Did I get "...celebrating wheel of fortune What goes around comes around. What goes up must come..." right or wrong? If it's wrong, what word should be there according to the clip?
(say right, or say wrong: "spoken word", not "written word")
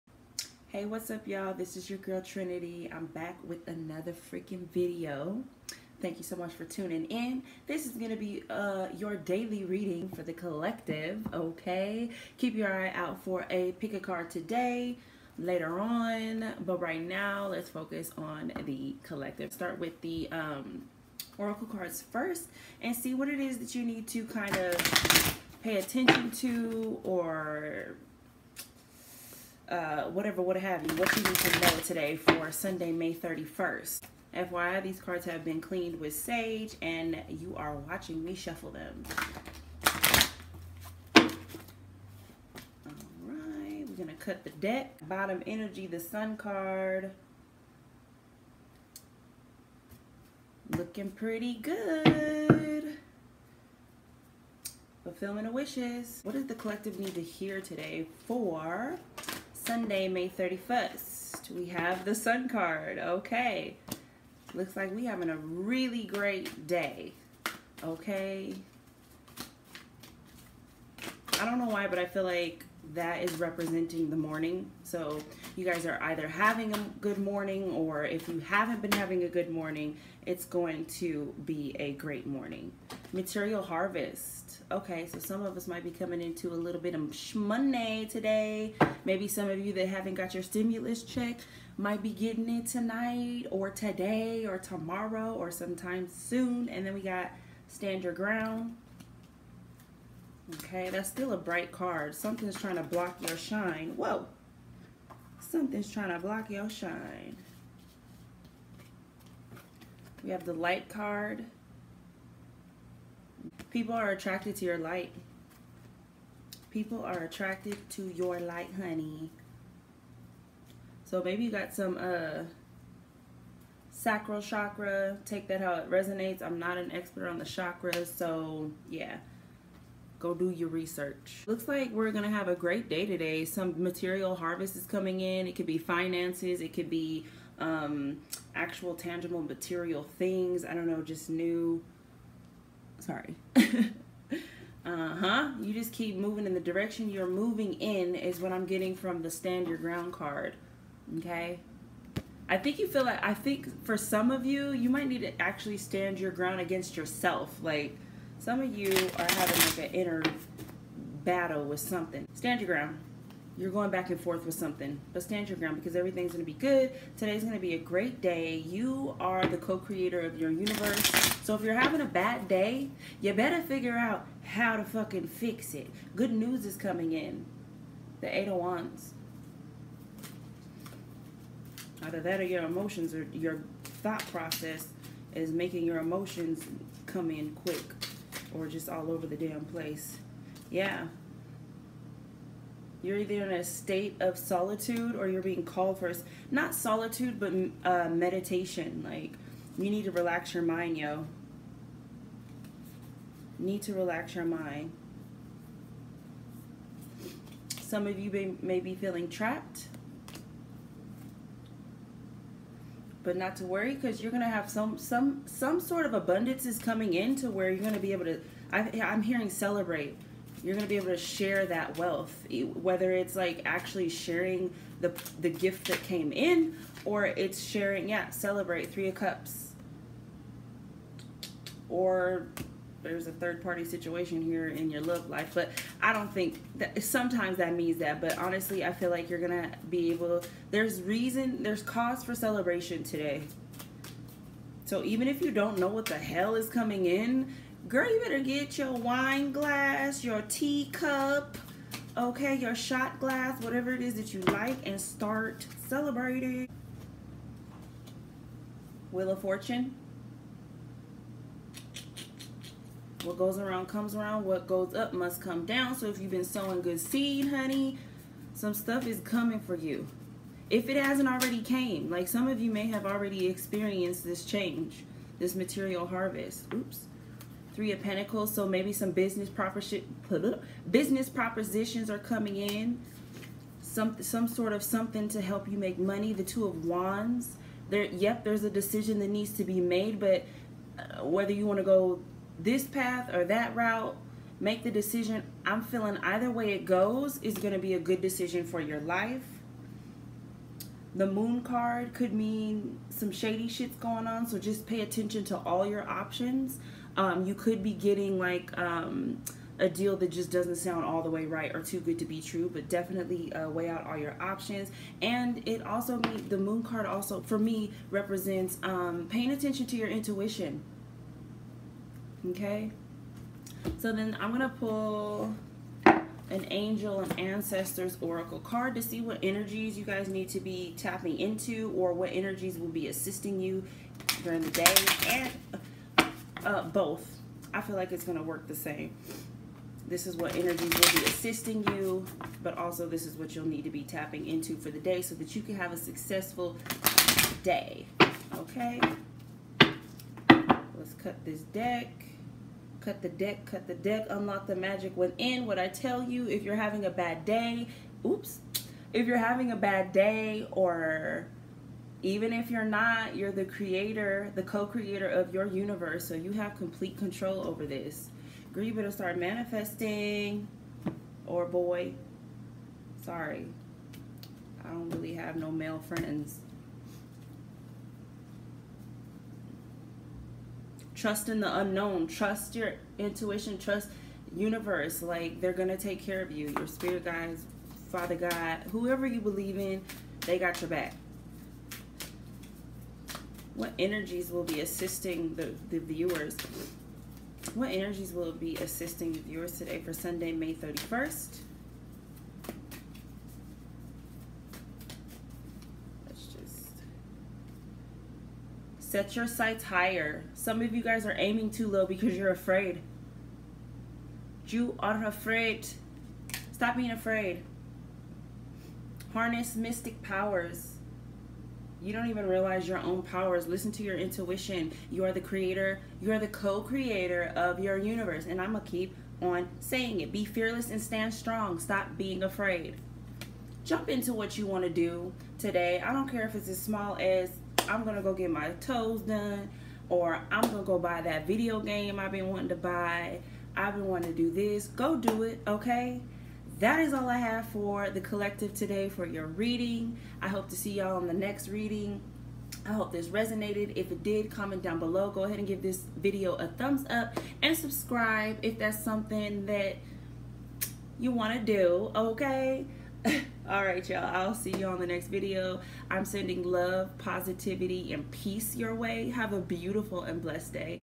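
right.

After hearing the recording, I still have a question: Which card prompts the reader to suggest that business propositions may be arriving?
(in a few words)
Three of Pentacles.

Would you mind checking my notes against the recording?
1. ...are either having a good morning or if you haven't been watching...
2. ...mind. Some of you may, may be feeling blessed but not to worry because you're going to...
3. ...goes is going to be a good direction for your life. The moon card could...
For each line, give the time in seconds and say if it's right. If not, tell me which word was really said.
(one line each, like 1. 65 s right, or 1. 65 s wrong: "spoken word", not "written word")
1. 75 s wrong: "having", not "watching"
2. 204 s wrong: "trapped", not "blessed"
3. 296 s wrong: "decision", not "direction".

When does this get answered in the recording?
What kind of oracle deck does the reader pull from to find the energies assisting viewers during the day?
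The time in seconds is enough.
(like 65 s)
326 s.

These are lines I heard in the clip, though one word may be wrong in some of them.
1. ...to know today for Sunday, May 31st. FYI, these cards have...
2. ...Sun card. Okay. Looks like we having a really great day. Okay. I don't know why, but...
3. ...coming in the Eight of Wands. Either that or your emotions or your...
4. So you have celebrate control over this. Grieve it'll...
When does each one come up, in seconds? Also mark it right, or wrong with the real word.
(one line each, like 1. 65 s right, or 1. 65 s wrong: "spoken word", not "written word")
1. 31 s right
2. 62 s right
3. 176 s right
4. 366 s wrong: "complete", not "celebrate".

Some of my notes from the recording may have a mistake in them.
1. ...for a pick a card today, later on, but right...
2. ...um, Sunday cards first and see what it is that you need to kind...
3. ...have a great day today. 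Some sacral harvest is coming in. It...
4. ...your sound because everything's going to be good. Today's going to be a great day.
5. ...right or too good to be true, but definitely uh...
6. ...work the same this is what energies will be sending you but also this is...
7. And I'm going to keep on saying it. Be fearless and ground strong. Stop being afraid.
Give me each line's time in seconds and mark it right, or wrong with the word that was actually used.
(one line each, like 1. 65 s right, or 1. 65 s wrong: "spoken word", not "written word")
1. 13 s right
2. 20 s wrong: "Oracle", not "Sunday"
3. 132 s wrong: "material", not "sacral"
4. 165 s wrong: "ground", not "sound"
5. 311 s right
6. 338 s wrong: "assisting", not "sending"
7. 428 s wrong: "stand", not "ground".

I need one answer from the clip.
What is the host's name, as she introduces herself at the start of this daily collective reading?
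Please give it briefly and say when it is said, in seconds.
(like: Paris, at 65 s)
Trinity, at 2 s.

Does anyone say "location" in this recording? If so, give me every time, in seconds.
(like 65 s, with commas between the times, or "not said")
not said.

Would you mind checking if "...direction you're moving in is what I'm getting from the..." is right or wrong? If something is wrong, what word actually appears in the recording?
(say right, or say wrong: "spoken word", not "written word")
right.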